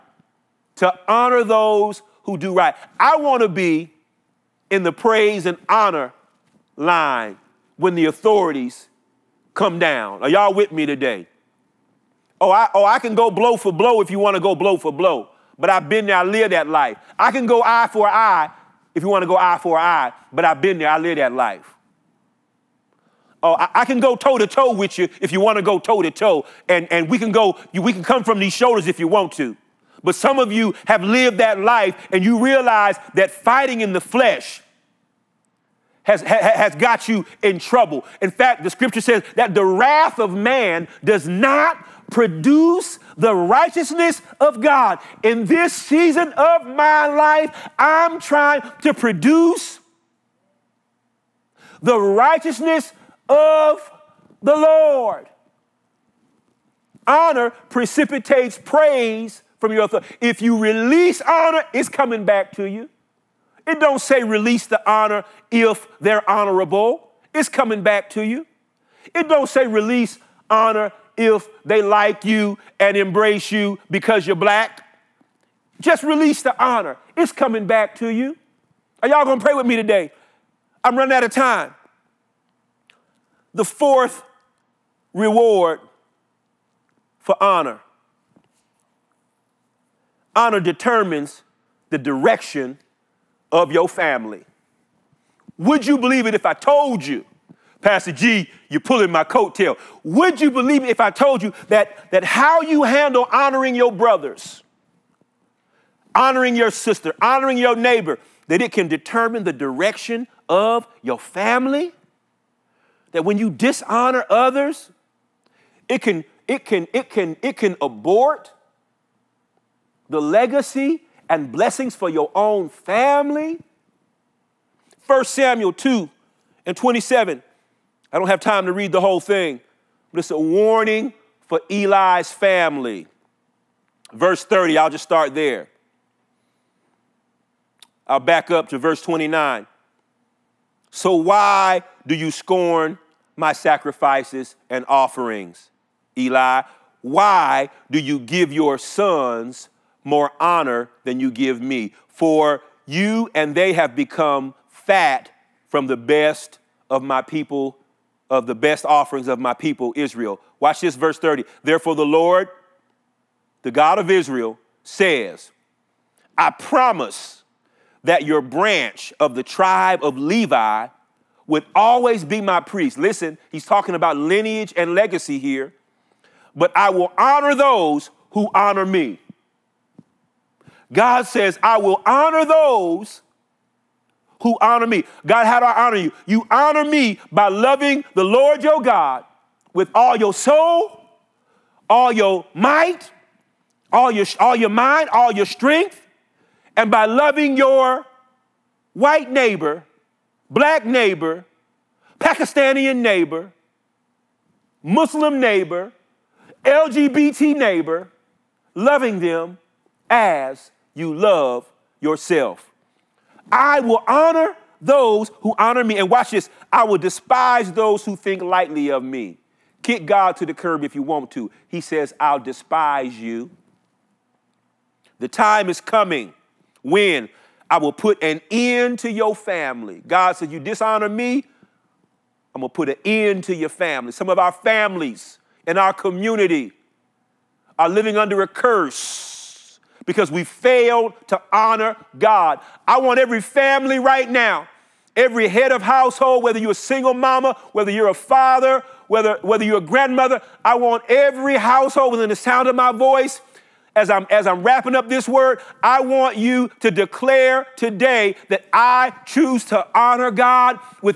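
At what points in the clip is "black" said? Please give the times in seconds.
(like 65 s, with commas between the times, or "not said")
74 s, 200 s.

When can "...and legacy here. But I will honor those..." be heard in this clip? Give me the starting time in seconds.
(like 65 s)
174 s.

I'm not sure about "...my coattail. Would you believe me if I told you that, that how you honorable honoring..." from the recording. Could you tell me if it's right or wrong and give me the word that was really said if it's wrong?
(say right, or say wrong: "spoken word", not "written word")
wrong: "handle", not "honorable".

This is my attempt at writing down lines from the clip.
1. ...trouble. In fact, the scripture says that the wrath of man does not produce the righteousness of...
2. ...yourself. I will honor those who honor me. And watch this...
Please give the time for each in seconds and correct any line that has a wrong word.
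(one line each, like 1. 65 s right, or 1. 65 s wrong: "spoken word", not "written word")
1. 37 s right
2. 211 s right.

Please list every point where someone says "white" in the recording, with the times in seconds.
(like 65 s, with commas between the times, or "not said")
198 s.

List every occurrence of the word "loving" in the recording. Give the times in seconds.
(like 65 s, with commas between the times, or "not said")
187 s, 197 s, 208 s.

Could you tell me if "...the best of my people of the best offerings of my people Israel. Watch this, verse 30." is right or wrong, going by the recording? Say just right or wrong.
right.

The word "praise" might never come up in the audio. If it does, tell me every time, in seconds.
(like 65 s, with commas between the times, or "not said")
4 s, 58 s.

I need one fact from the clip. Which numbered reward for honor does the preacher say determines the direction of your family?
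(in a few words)
Fourth.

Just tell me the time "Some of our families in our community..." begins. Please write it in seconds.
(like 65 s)
234 s.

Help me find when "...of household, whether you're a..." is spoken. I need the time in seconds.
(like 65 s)
245 s.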